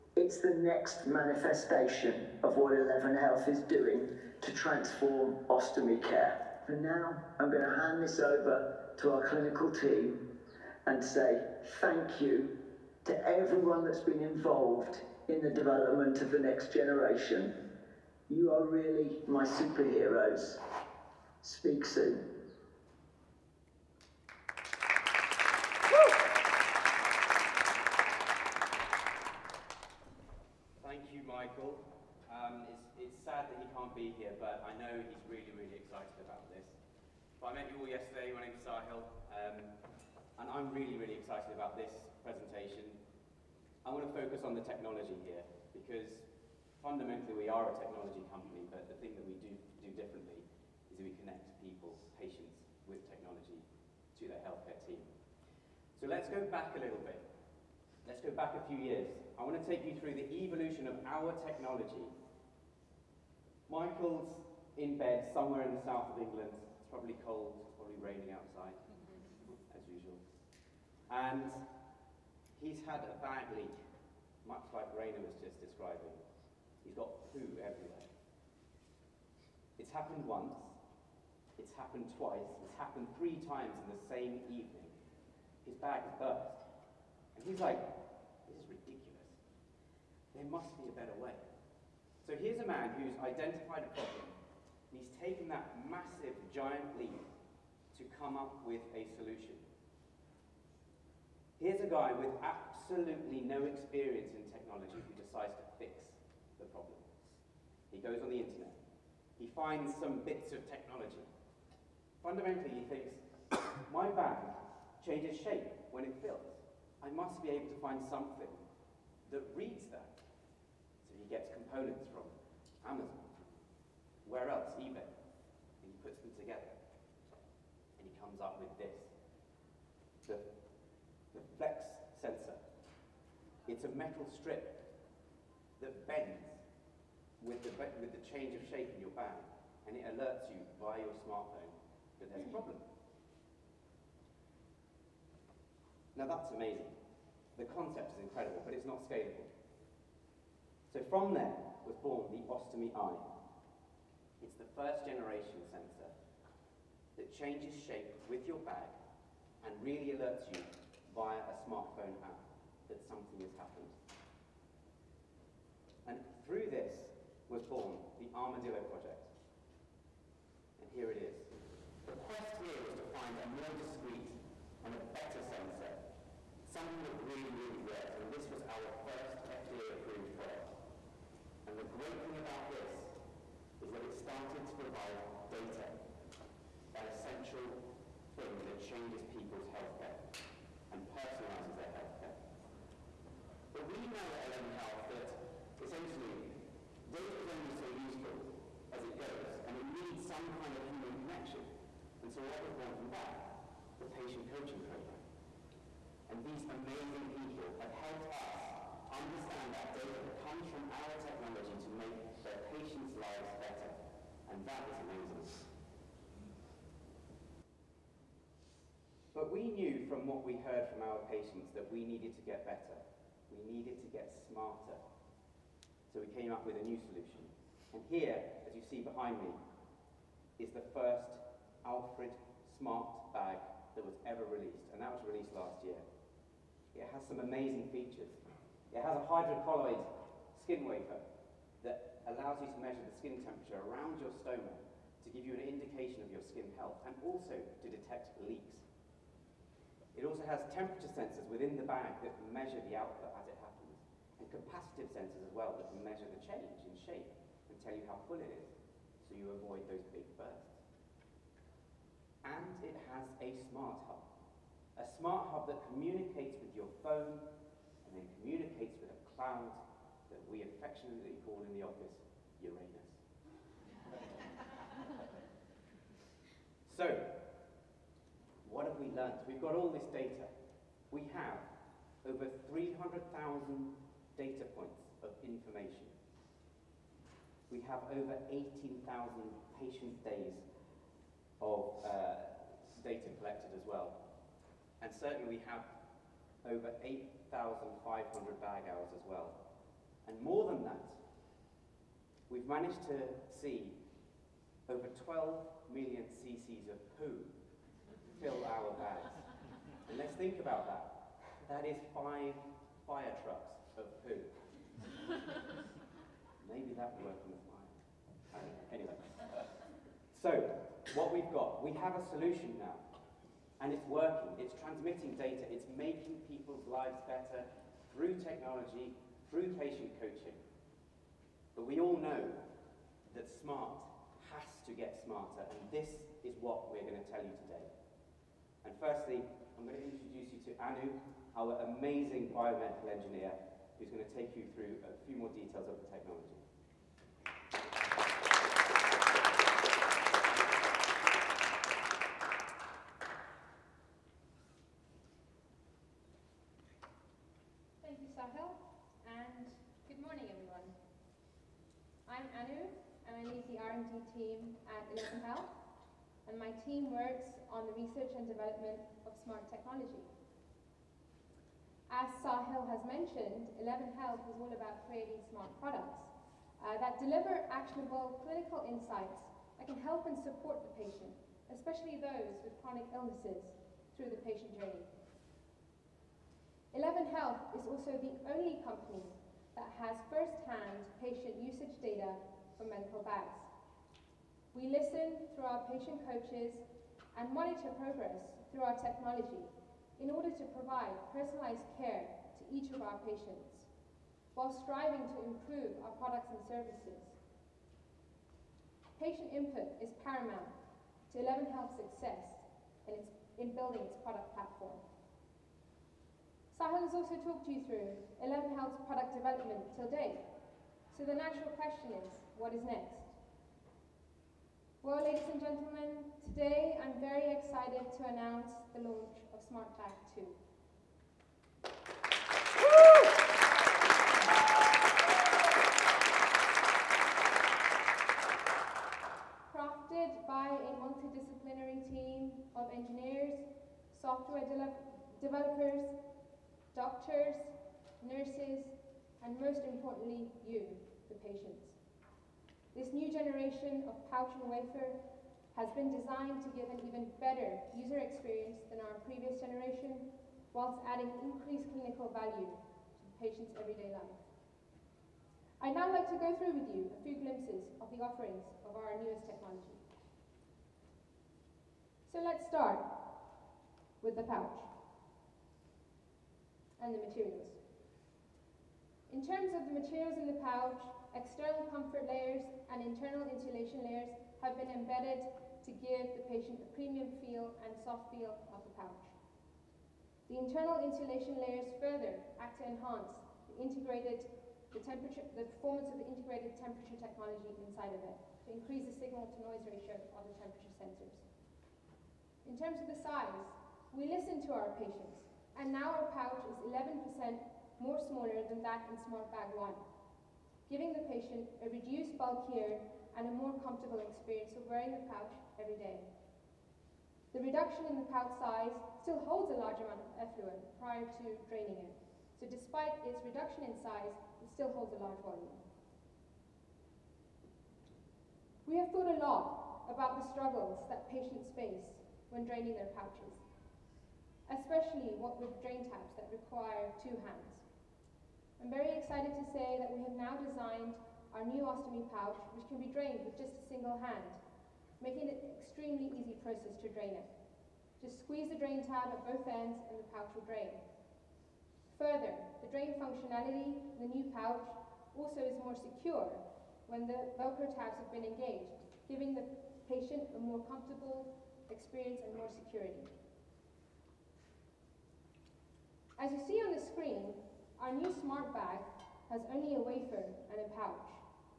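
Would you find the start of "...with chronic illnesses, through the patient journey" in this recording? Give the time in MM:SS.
06:22.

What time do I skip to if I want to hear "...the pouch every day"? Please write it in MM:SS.
08:35.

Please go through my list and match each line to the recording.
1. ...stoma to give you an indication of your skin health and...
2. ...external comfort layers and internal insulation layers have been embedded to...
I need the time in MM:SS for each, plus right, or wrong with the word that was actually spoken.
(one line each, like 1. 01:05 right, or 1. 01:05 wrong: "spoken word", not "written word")
1. 04:04 right
2. 08:01 right.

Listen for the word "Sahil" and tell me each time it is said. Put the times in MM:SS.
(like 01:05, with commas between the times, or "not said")
00:38, 05:58, 06:12, 06:56.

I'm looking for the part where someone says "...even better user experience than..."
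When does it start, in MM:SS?
07:37.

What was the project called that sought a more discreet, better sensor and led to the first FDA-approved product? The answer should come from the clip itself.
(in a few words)
Armadillo Project.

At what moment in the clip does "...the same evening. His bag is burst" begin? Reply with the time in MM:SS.
01:23.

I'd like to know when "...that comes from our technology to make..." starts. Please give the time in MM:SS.
03:30.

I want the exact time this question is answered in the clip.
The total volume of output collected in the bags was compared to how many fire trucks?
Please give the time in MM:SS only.
05:12.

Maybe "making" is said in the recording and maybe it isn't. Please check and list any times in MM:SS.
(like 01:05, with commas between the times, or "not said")
05:25, 09:05.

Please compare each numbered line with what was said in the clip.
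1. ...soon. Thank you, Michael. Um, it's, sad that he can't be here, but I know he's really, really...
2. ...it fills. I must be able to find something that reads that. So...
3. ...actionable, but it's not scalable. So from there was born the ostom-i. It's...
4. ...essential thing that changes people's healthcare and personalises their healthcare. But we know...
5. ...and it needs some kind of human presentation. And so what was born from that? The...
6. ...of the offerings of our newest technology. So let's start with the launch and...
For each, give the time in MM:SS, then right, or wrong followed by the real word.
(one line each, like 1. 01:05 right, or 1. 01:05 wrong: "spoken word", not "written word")
1. 00:21 right
2. 01:56 right
3. 02:28 wrong: "incredible", not "actionable"
4. 03:07 right
5. 03:19 wrong: "connection", not "presentation"
6. 07:48 wrong: "pouch", not "launch".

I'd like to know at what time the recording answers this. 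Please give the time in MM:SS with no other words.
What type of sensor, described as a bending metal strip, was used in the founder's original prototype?
02:11.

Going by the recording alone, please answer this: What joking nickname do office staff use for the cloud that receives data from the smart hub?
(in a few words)
Uranus.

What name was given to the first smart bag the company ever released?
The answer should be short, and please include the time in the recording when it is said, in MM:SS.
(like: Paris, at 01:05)
Alfred, at 03:51.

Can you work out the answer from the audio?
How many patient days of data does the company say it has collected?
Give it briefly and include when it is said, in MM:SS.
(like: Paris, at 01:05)
18,000, at 04:48.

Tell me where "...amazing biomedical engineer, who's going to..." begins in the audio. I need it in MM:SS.
05:41.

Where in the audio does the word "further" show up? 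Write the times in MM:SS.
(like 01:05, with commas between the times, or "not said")
08:12, 09:12.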